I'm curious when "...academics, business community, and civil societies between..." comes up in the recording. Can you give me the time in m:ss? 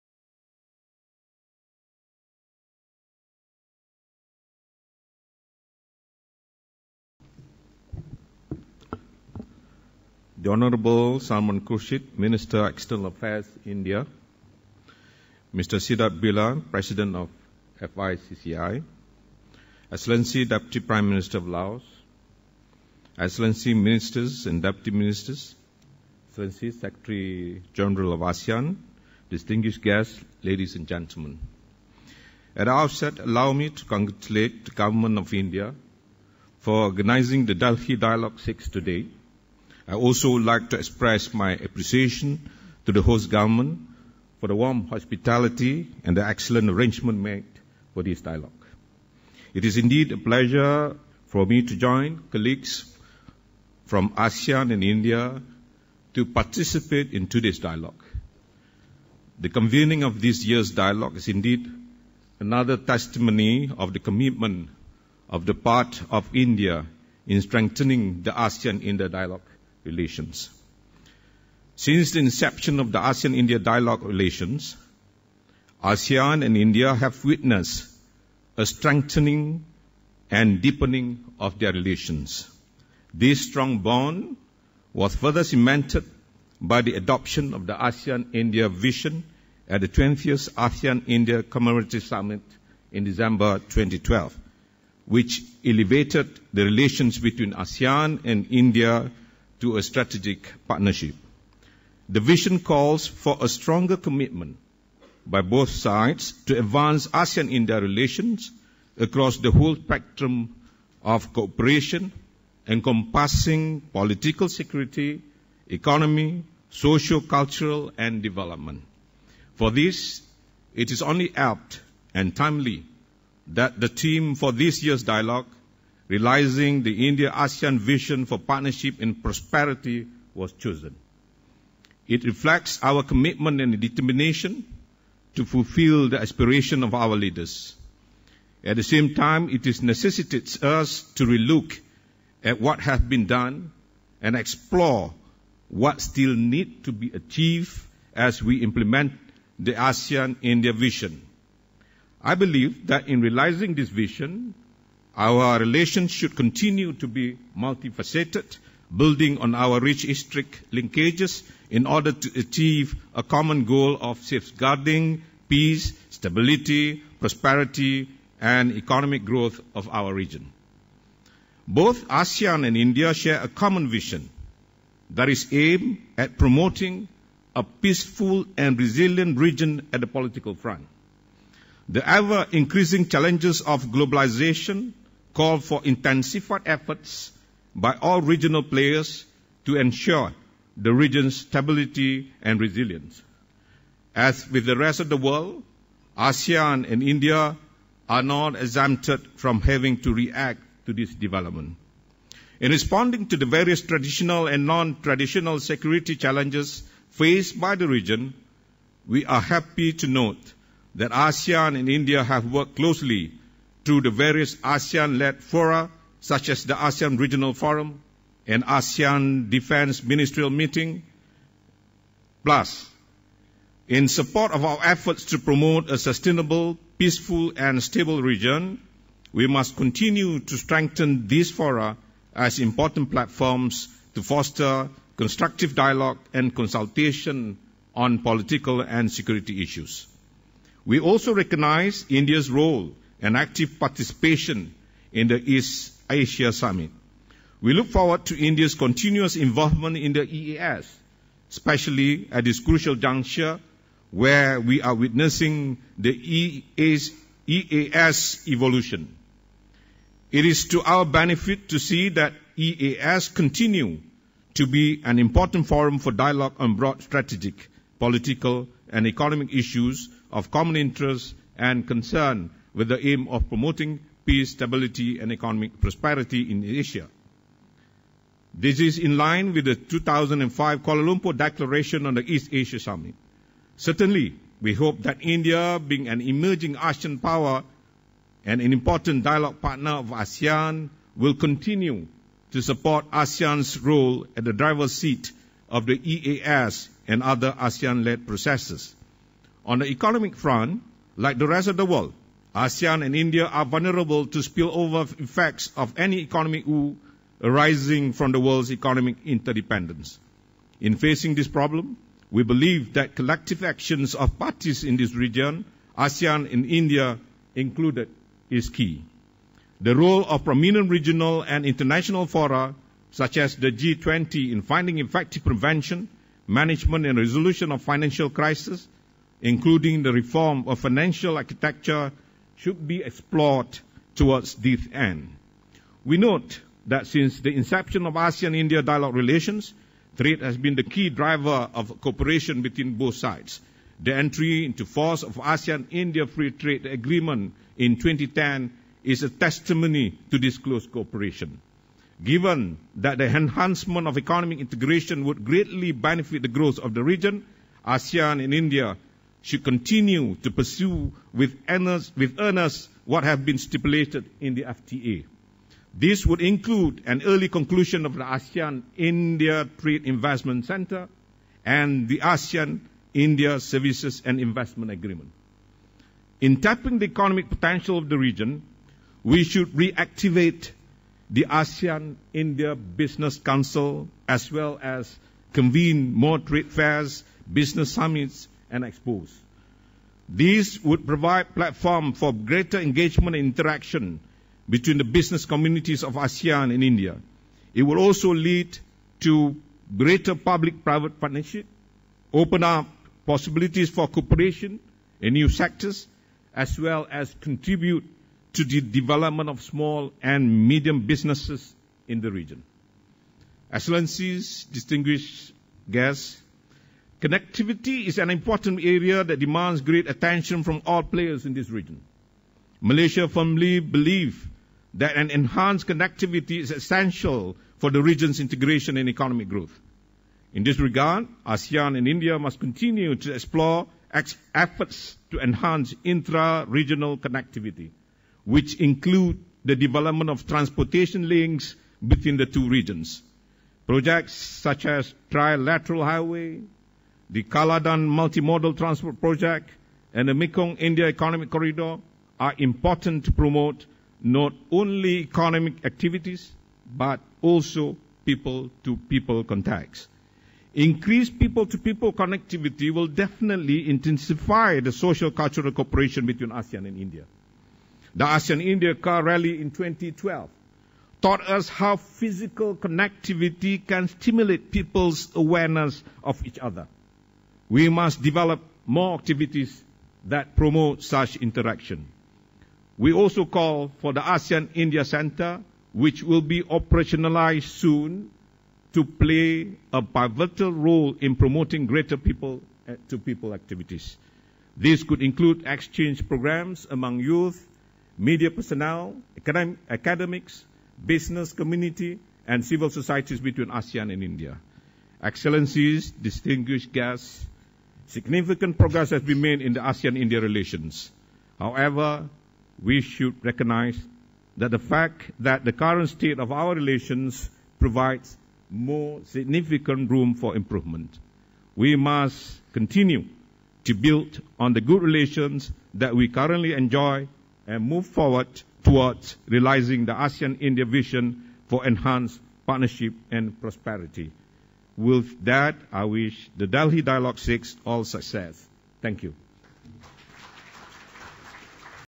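8:19.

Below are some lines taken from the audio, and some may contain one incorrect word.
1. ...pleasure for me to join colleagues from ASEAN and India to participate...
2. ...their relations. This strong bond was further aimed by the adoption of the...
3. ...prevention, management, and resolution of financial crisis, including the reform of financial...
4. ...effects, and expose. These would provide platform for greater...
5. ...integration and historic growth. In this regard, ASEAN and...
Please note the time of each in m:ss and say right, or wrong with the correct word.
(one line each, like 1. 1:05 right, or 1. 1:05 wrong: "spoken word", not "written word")
1. 0:50 right
2. 1:21 wrong: "cemented", not "aimed"
3. 5:25 right
4. 6:27 wrong: "summits", not "effects"
5. 7:08 wrong: "economic", not "historic".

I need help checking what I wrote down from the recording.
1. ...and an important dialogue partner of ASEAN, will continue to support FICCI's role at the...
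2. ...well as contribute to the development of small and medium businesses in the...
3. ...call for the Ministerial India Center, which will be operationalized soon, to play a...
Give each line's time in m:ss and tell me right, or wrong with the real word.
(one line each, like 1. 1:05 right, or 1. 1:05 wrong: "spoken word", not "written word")
1. 4:48 wrong: "ASEAN", not "FICCI"
2. 6:46 right
3. 8:03 wrong: "ASEAN", not "Ministerial".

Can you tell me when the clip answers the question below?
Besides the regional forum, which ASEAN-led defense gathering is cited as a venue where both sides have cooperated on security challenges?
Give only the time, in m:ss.
3:38.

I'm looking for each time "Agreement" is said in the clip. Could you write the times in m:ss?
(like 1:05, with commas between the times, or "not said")
5:46, 6:14.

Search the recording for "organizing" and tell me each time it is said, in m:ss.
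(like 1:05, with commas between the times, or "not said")
0:36.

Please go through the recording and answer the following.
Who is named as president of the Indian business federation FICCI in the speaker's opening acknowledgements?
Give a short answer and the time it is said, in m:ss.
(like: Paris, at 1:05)
Siddharth Birla, at 0:15.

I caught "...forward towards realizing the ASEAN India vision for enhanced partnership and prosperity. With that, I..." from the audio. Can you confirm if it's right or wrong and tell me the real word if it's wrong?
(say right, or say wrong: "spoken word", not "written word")
right.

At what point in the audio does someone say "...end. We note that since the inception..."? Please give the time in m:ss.
5:34.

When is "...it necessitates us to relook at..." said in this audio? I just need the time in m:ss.
2:19.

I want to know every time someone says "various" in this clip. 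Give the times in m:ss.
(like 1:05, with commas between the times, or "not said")
3:23, 3:34.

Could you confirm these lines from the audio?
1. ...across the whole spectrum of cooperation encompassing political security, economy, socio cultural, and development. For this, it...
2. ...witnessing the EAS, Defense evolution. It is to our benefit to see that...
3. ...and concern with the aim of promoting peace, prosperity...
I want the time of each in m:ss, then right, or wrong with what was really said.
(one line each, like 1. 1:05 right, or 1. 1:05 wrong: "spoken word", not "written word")
1. 1:48 right
2. 4:14 wrong: "EAS", not "Defense"
3. 4:31 wrong: "stability", not "prosperity".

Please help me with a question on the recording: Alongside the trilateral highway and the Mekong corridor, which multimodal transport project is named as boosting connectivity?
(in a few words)
Kaladan Multimodal Transport Project.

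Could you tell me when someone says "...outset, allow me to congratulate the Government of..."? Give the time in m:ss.
0:32.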